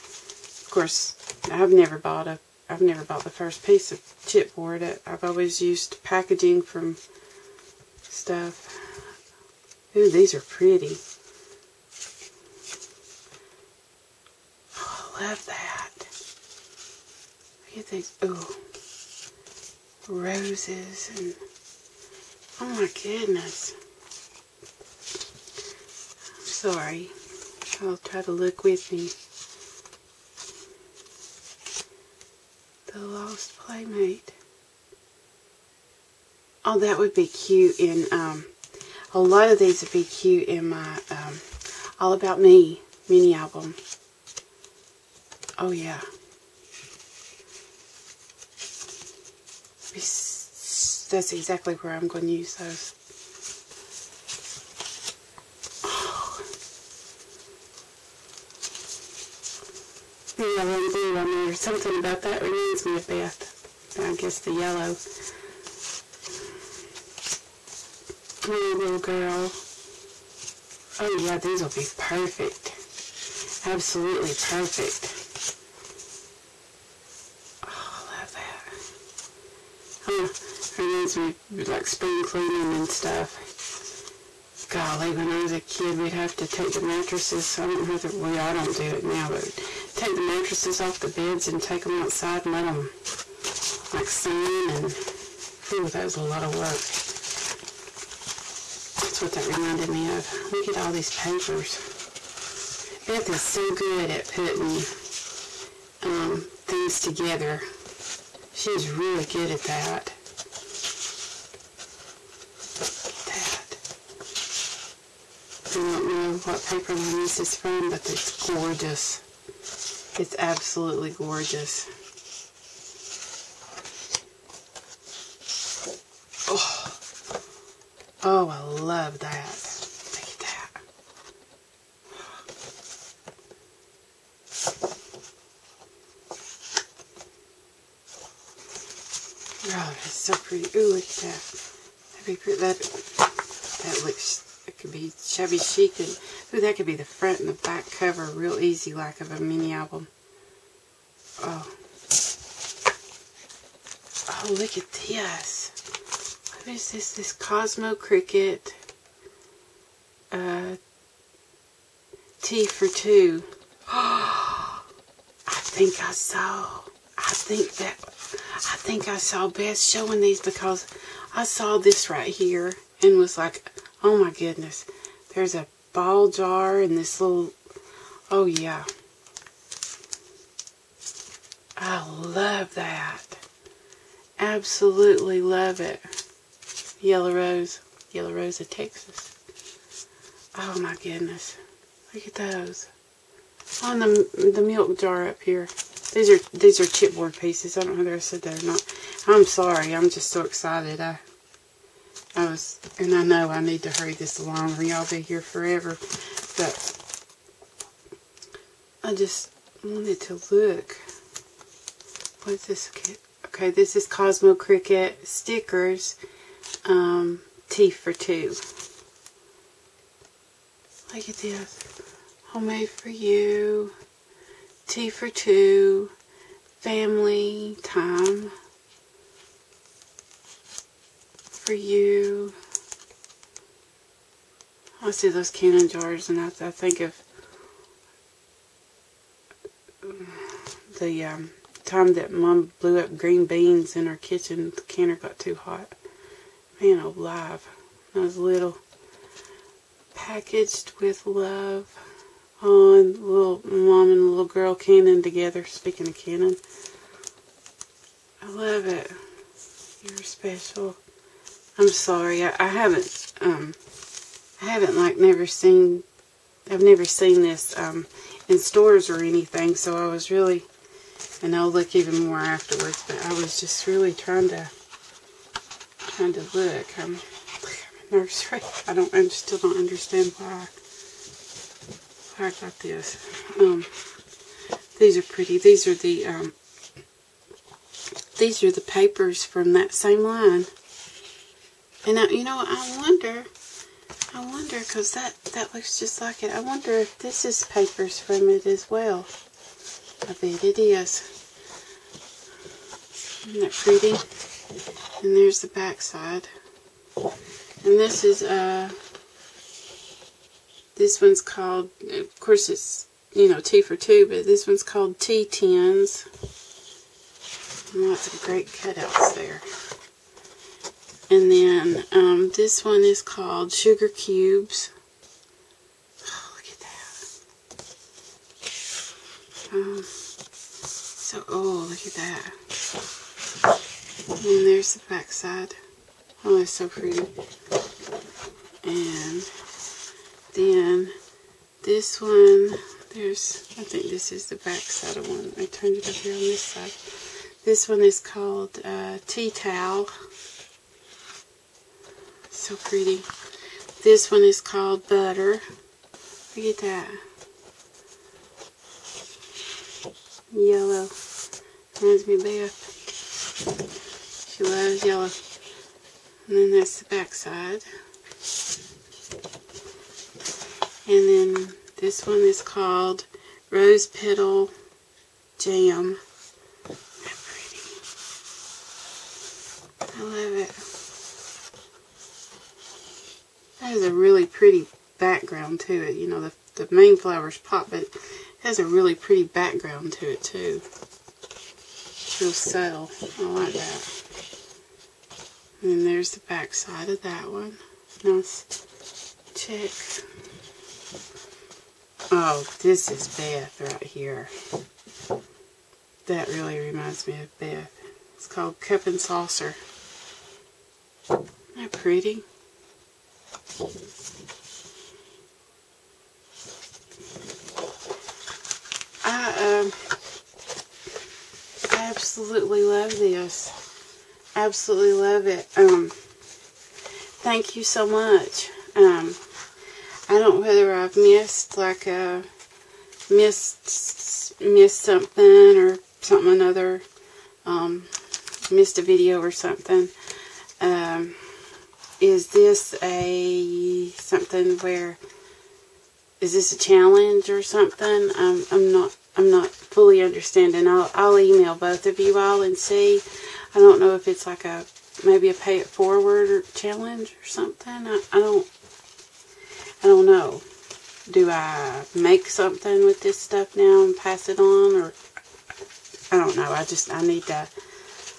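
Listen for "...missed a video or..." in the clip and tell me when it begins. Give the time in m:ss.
7:18.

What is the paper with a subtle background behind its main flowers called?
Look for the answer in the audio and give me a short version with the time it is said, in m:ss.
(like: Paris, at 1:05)
Rose Petal Jam, at 6:13.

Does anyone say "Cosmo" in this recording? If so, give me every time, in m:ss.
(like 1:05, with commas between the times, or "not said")
2:37, 3:34.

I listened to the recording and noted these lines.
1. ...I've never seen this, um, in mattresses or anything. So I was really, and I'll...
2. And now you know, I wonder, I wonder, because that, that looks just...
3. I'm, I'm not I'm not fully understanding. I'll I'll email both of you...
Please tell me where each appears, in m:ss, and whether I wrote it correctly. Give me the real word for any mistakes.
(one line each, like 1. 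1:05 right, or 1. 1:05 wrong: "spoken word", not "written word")
1. 4:26 wrong: "stores", not "mattresses"
2. 4:52 right
3. 7:28 right.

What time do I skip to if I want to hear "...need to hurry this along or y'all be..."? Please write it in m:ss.
3:23.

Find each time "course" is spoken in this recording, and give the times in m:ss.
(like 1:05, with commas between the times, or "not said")
0:00, 5:12.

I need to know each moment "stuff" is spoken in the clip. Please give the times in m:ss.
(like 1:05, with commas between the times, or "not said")
0:08, 1:22, 7:43.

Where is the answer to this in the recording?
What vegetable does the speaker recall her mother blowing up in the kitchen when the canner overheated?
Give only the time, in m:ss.
4:03.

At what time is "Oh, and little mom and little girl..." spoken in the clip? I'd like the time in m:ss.
4:12.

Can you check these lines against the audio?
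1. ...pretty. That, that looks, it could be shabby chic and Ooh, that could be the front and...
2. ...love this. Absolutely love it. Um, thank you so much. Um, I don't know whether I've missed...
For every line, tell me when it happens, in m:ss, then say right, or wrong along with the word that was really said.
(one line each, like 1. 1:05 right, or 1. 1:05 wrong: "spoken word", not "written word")
1. 2:22 right
2. 7:02 right.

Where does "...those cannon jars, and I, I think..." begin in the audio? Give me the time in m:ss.
3:55.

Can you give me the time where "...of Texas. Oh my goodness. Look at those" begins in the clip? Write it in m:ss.
3:08.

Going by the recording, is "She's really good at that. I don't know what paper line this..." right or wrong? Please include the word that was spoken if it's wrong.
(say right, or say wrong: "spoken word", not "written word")
right.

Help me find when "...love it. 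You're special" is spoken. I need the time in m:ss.
4:18.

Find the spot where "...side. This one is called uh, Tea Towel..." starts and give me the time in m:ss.
5:46.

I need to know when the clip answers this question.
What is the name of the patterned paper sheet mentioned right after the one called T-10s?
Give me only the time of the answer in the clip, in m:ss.
5:23.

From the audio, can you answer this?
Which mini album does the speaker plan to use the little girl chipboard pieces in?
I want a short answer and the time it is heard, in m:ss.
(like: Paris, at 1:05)
All About Me, at 0:41.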